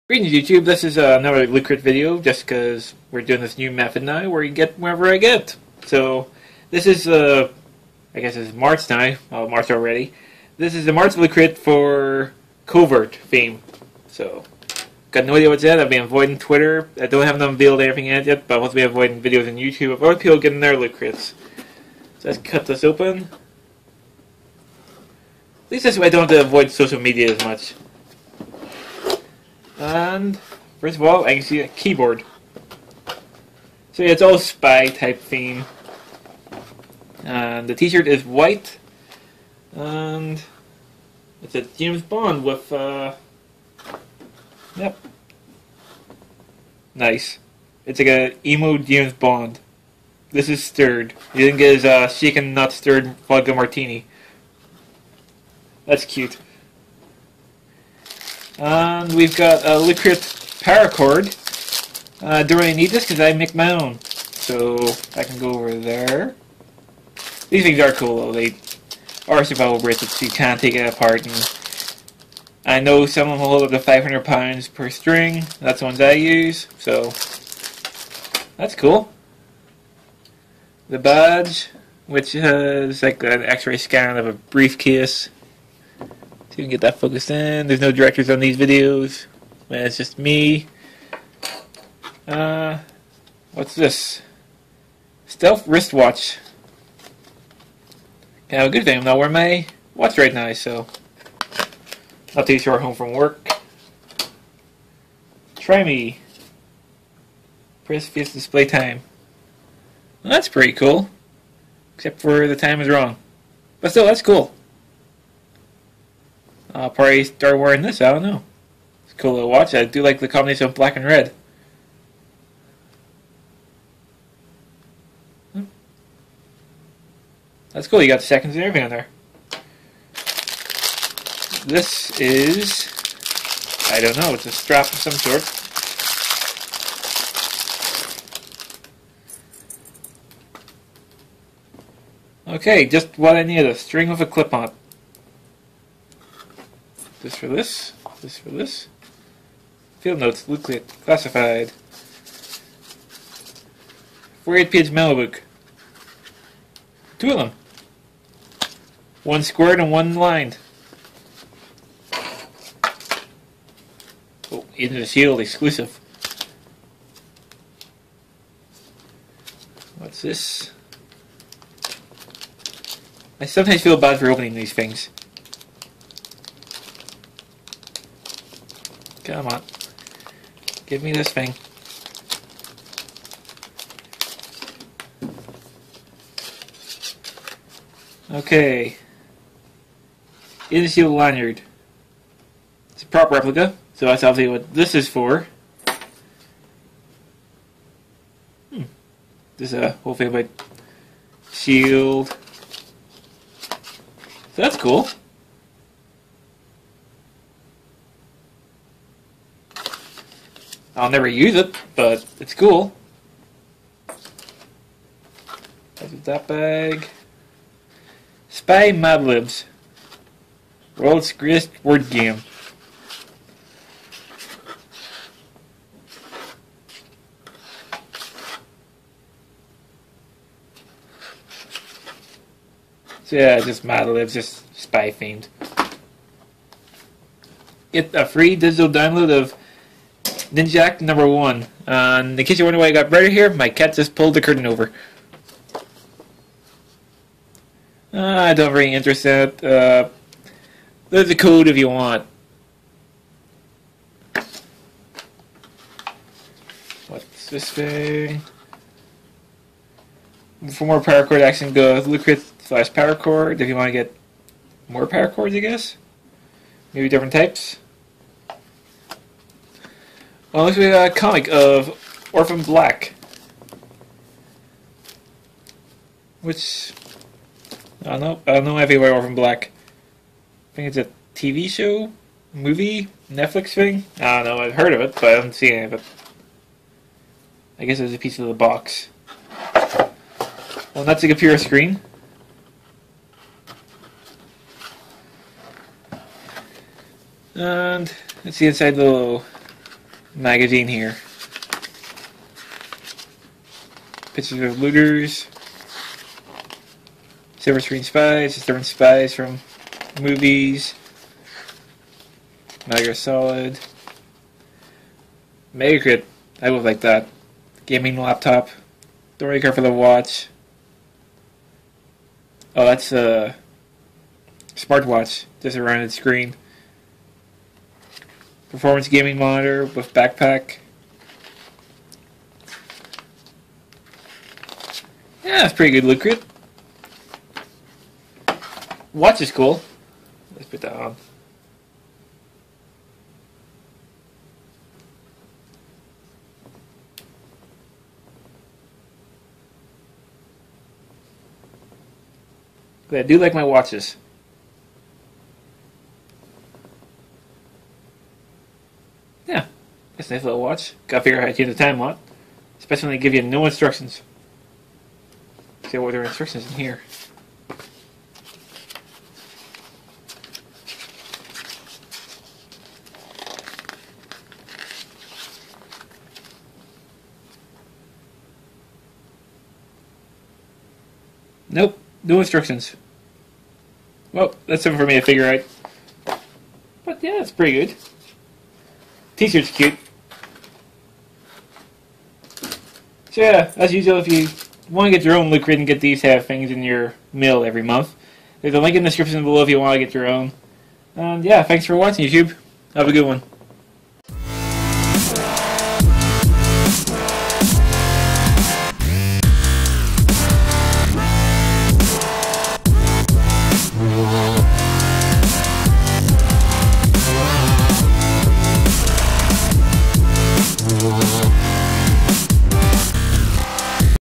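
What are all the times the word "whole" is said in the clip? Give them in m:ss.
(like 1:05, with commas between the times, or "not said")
3:20.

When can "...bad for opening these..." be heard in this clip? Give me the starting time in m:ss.
2:53.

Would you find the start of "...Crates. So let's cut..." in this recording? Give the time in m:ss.
0:20.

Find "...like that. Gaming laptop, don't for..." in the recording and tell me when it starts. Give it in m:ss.
5:16.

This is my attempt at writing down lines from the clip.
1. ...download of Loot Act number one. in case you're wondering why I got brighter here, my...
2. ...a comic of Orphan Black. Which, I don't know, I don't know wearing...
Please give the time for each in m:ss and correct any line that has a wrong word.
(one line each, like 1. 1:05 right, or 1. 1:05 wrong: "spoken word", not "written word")
1. 3:58 wrong: "Ninja", not "Loot"
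2. 4:31 wrong: "anything", not "wearing".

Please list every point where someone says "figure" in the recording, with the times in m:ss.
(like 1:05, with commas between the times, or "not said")
6:01, 6:25.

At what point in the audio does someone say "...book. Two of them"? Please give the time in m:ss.
2:35.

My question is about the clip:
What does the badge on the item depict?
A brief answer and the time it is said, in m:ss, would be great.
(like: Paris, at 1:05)
X-ray scan of a briefcase, at 1:23.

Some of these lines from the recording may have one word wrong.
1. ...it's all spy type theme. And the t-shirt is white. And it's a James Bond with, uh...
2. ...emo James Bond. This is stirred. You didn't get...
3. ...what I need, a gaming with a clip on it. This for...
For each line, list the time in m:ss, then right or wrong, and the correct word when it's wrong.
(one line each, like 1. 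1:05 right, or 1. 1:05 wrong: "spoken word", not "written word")
1. 0:34 right
2. 0:48 right
3. 2:23 wrong: "string", not "gaming".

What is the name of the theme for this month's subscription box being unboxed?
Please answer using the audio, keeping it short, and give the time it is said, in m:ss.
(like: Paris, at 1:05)
Covert, at 0:12.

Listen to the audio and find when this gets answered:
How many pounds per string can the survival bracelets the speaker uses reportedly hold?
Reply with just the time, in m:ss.
1:13.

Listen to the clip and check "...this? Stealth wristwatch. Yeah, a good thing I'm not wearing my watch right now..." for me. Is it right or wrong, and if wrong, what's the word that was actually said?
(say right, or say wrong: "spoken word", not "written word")
right.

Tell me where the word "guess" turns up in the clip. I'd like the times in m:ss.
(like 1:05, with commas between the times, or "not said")
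0:08, 4:25, 4:47.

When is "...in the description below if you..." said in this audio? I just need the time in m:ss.
6:38.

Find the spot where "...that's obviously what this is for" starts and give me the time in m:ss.
3:14.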